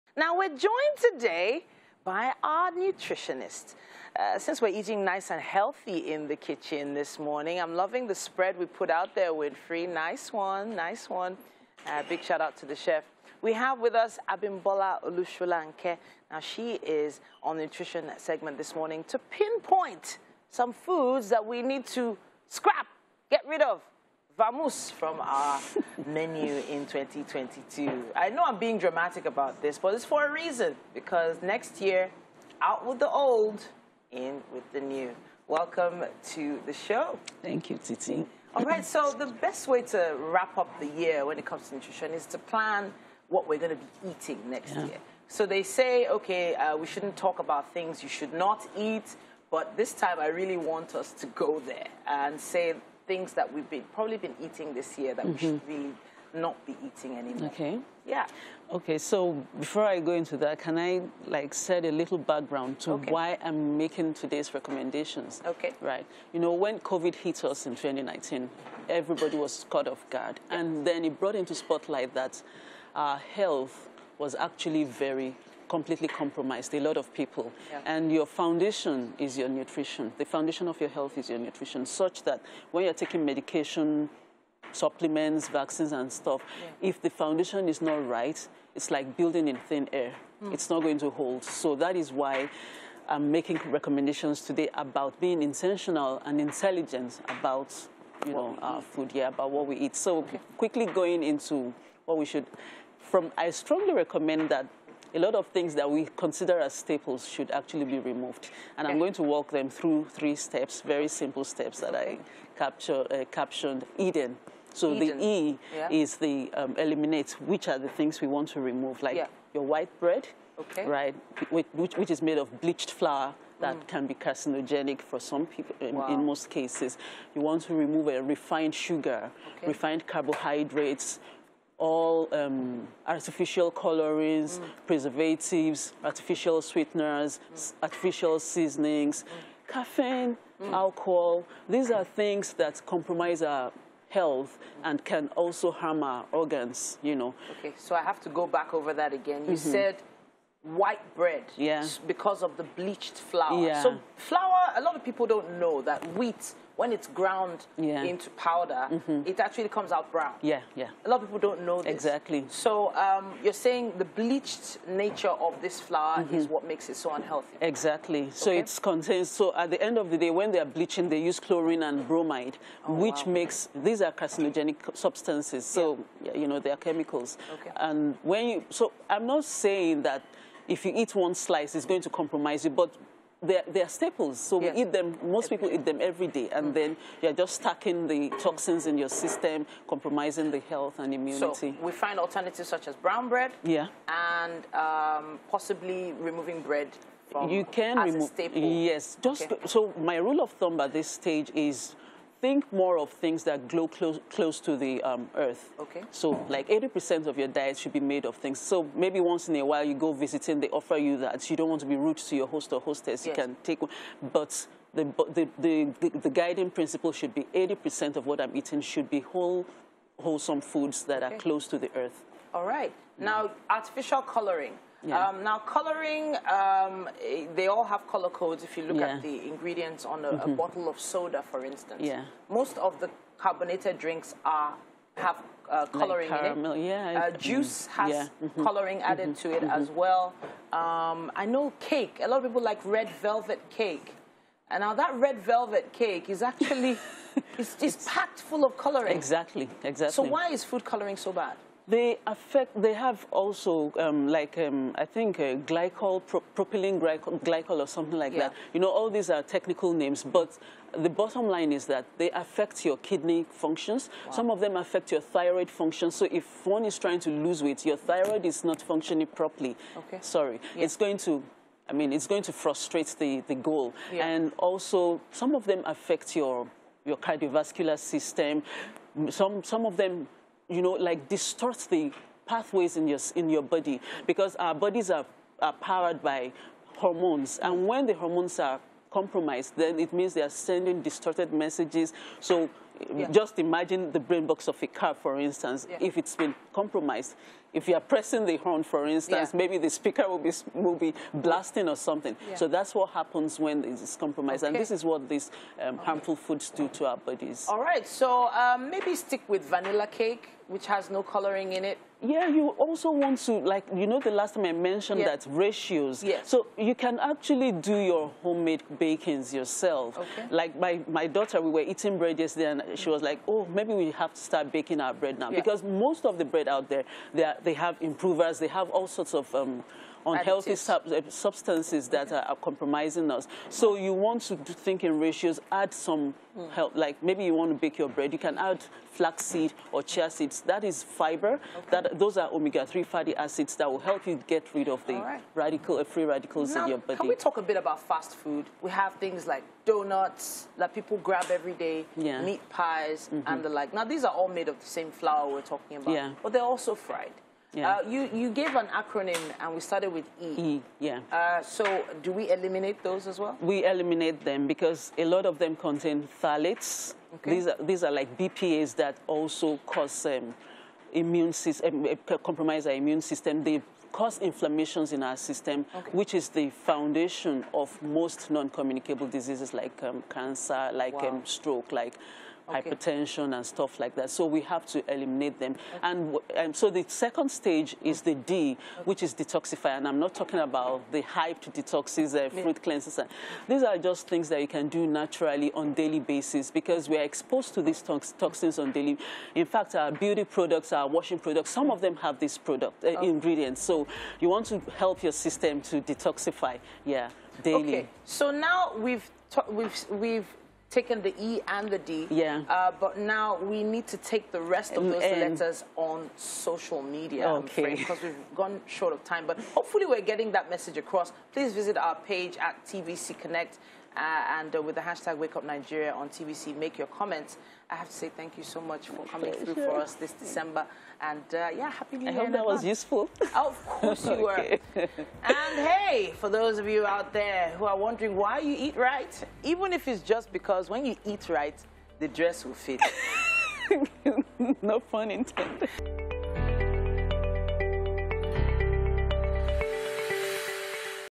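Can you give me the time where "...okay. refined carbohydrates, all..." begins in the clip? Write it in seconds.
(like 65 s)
129 s.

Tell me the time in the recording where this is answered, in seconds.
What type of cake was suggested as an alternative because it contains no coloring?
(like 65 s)
309 s.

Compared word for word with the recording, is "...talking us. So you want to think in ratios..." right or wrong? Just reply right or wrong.
wrong.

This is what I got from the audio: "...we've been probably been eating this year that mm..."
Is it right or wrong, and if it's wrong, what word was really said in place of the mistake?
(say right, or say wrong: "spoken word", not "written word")
right.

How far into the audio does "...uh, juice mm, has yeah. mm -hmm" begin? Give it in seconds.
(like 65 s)
237 s.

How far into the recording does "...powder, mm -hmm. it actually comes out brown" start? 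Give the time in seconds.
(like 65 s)
158 s.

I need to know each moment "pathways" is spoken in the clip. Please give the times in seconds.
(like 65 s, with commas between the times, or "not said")
282 s.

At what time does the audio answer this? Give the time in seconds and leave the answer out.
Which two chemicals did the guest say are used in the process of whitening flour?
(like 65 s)
171 s.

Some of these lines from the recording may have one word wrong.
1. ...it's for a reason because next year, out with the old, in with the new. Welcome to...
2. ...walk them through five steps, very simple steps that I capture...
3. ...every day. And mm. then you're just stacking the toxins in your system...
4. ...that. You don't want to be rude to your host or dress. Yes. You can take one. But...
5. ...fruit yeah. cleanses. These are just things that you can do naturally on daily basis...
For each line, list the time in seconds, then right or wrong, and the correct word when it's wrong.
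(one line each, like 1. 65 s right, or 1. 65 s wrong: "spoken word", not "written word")
1. 29 s right
2. 109 s wrong: "three", not "five"
3. 186 s right
4. 211 s wrong: "hostess", not "dress"
5. 392 s right.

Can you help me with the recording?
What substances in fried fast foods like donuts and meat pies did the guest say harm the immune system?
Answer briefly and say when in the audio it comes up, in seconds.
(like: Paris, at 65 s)
phthalates, at 366 s.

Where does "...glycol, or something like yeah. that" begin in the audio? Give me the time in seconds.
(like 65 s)
257 s.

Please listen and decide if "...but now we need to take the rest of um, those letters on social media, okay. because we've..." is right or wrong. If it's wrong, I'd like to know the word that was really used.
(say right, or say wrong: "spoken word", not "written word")
right.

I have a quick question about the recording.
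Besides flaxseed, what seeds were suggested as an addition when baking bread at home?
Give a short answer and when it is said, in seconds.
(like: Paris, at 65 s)
chia seeds, at 340 s.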